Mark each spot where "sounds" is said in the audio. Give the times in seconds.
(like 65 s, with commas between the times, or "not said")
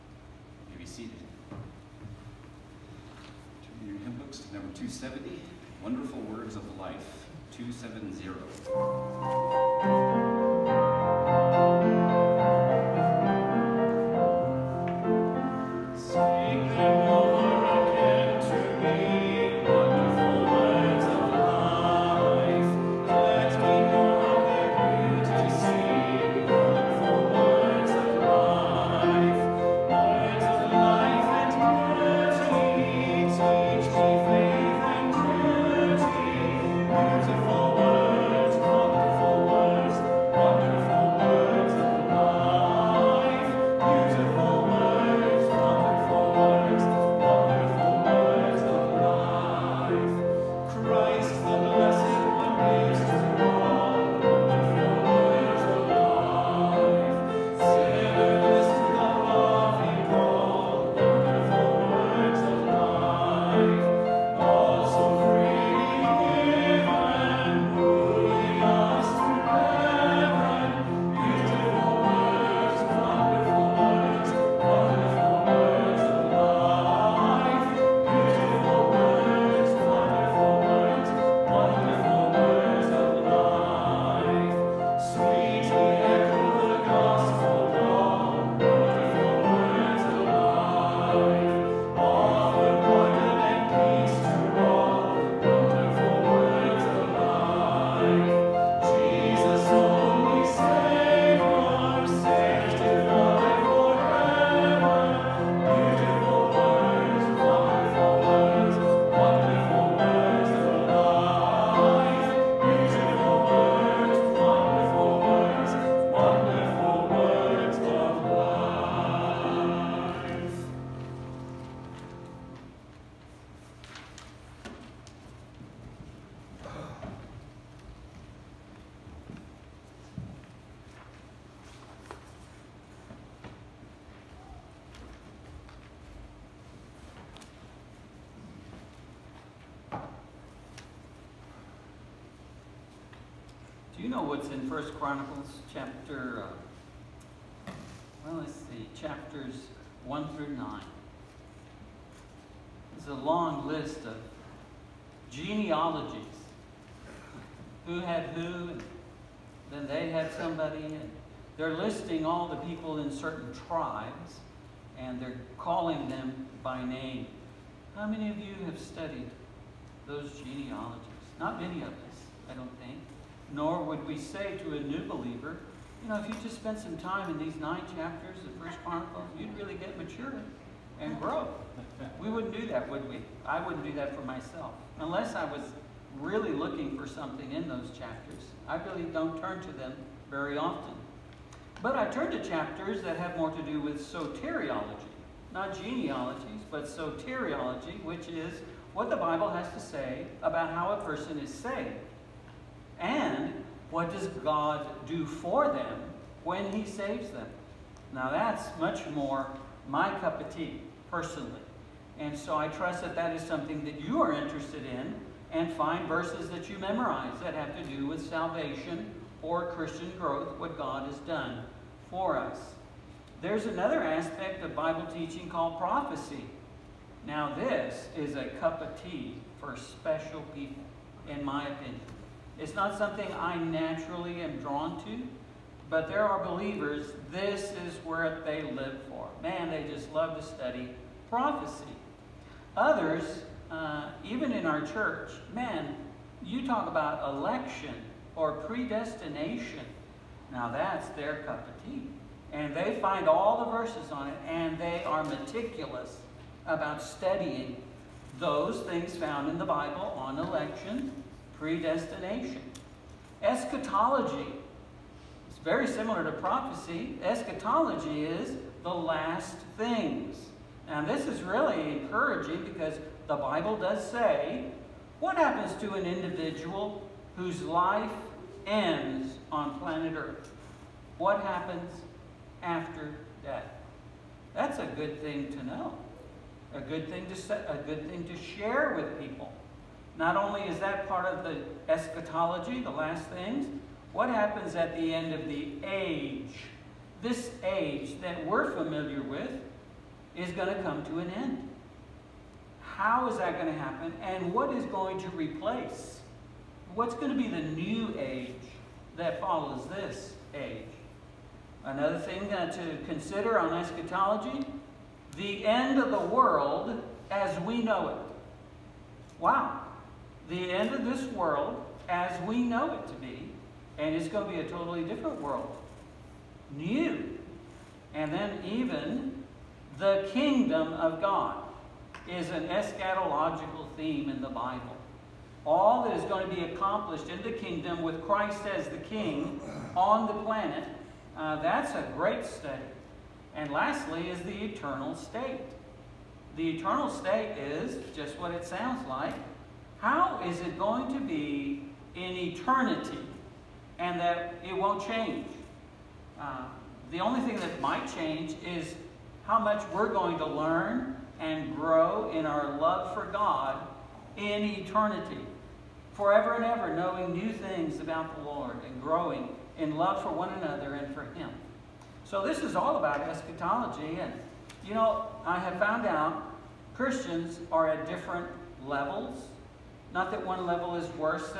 348 s.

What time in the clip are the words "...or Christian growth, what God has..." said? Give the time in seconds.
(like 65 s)
219 s.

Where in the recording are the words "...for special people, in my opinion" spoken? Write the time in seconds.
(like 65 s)
229 s.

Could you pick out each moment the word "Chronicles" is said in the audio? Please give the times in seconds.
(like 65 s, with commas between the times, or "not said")
144 s, 178 s.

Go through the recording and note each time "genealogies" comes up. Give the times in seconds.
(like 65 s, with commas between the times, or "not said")
155 s, 170 s, 195 s.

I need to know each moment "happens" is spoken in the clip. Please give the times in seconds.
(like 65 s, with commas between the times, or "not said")
275 s, 281 s, 294 s, 303 s.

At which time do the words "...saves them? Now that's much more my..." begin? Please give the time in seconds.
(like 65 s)
206 s.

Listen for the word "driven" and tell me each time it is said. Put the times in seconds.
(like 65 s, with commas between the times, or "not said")
not said.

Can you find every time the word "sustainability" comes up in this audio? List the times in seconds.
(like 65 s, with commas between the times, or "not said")
not said.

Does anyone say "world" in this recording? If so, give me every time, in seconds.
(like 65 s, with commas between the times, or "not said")
316 s, 321 s, 325 s.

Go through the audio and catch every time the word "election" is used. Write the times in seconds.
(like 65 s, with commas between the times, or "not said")
247 s, 260 s.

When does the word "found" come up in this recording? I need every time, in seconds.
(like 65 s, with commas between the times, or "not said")
259 s, 375 s.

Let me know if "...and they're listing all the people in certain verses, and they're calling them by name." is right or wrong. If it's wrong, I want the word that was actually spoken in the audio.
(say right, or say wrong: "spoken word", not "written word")
wrong: "tribes", not "verses".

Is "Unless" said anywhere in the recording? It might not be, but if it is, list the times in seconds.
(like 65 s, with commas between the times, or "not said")
184 s.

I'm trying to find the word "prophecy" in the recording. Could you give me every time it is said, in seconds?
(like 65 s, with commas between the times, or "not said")
225 s, 241 s, 266 s.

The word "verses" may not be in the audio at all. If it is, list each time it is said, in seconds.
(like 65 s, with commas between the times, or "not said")
216 s, 253 s.